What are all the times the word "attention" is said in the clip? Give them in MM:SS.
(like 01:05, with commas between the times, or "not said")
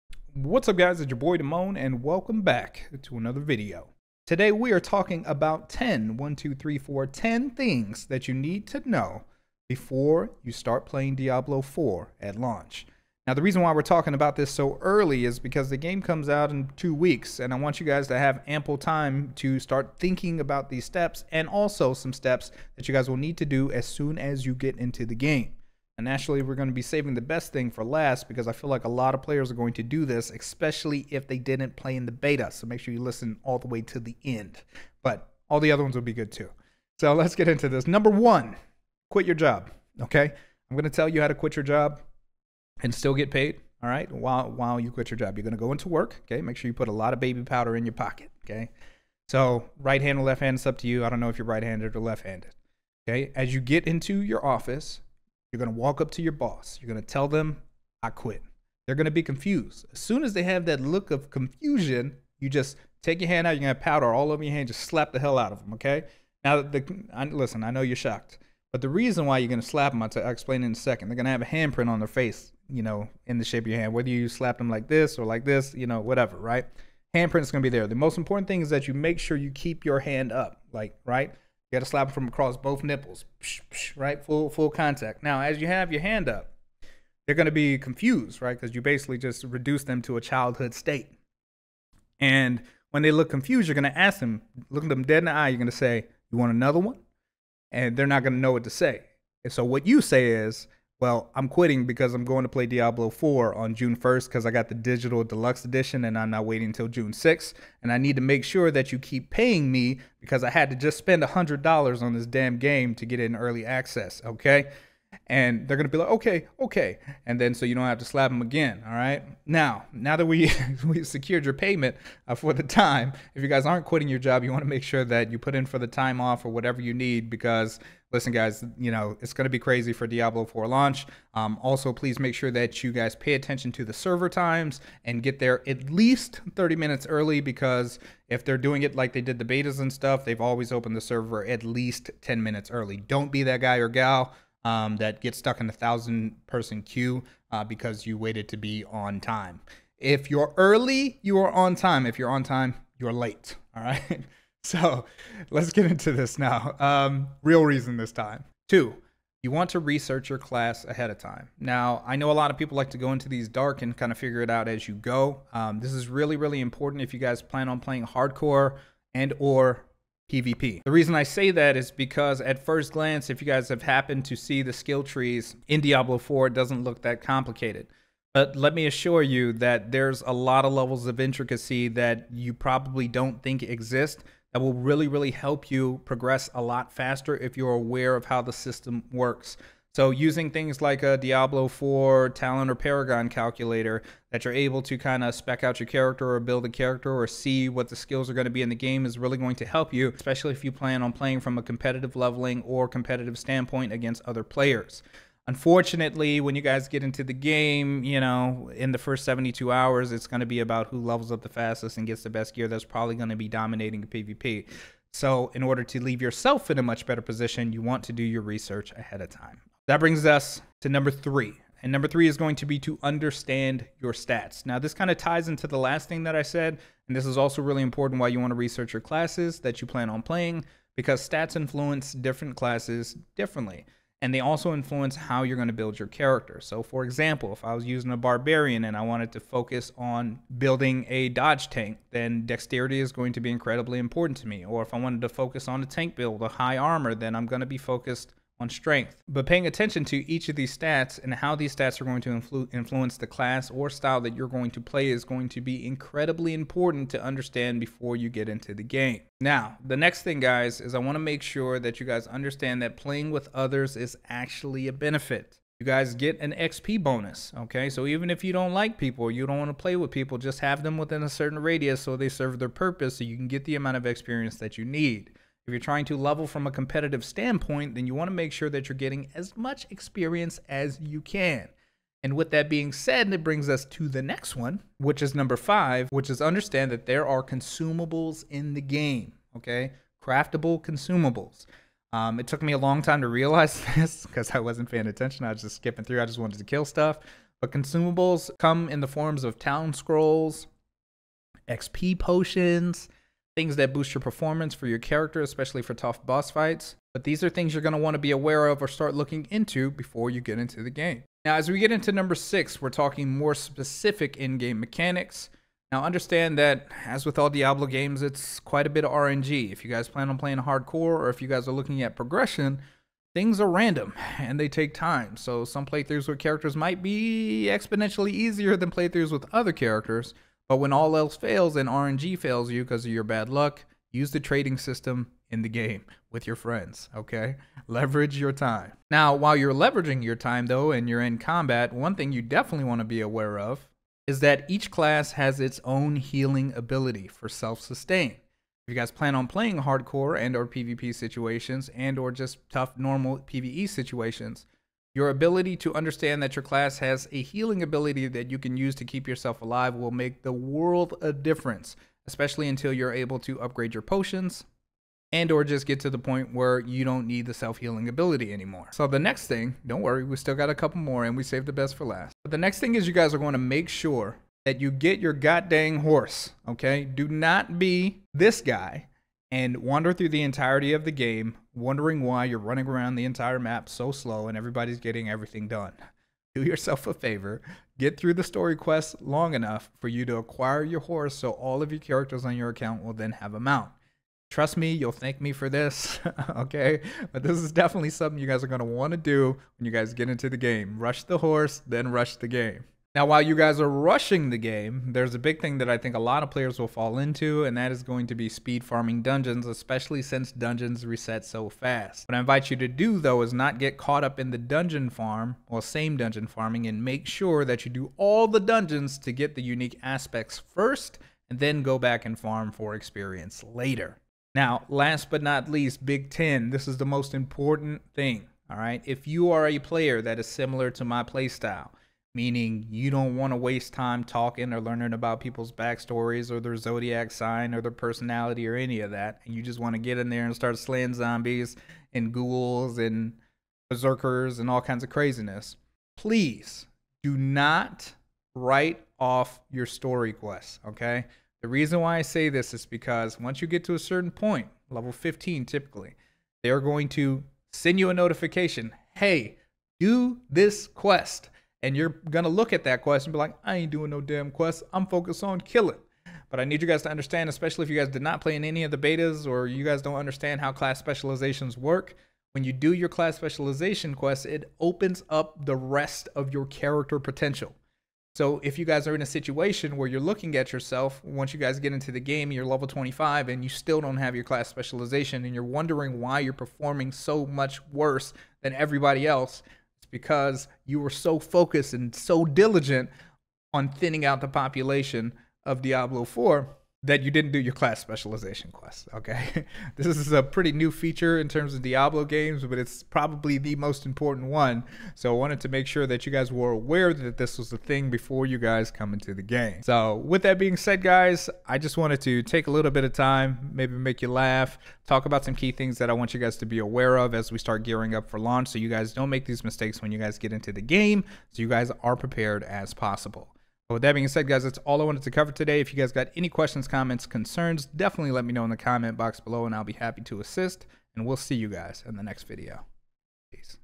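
02:13, 04:09, 04:55.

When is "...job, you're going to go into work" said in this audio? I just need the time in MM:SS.
00:45.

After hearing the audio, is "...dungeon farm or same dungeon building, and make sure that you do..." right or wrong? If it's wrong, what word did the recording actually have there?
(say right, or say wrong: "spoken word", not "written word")
wrong: "farming", not "building".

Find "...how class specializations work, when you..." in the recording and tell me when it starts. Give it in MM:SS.
07:50.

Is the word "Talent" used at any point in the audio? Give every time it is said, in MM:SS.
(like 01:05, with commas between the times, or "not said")
03:12.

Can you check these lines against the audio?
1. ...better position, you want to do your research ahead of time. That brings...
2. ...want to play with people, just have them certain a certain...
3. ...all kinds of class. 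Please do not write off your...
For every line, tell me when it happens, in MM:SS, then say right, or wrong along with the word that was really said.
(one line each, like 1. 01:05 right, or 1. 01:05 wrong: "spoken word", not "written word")
1. 03:37 right
2. 04:29 wrong: "within", not "certain"
3. 07:24 wrong: "craziness", not "class".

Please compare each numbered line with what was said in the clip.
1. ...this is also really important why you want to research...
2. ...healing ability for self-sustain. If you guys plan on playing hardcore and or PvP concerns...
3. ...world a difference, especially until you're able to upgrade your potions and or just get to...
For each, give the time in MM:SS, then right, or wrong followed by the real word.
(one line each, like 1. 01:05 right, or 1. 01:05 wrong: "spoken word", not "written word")
1. 03:47 right
2. 05:46 wrong: "situations", not "concerns"
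3. 06:00 right.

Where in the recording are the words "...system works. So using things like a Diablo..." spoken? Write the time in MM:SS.
03:08.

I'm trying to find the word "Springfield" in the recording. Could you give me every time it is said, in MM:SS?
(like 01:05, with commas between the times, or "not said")
not said.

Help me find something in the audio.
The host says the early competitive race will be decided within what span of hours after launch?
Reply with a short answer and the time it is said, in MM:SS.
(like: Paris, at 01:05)
72 hours, at 03:29.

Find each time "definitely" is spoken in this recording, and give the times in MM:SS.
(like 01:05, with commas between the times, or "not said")
05:42, 06:37, 08:47.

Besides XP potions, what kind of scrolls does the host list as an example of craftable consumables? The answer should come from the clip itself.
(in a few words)
town scrolls.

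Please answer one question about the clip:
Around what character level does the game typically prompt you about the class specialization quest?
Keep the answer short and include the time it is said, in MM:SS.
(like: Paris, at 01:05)
15, at 07:35.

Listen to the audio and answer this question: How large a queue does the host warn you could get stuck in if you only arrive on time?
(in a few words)
a thousand person.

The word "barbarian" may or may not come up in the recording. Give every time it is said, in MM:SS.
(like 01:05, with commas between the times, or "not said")
03:58.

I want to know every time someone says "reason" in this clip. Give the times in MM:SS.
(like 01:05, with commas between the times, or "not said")
00:13, 01:08, 02:37, 02:50, 07:31.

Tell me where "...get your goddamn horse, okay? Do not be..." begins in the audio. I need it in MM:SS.
06:14.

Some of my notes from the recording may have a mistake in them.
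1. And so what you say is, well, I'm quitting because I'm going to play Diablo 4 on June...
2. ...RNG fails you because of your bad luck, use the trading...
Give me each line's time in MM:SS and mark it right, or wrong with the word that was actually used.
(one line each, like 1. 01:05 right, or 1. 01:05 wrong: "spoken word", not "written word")
1. 01:39 right
2. 05:31 right.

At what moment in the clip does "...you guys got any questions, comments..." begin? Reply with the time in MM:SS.
08:45.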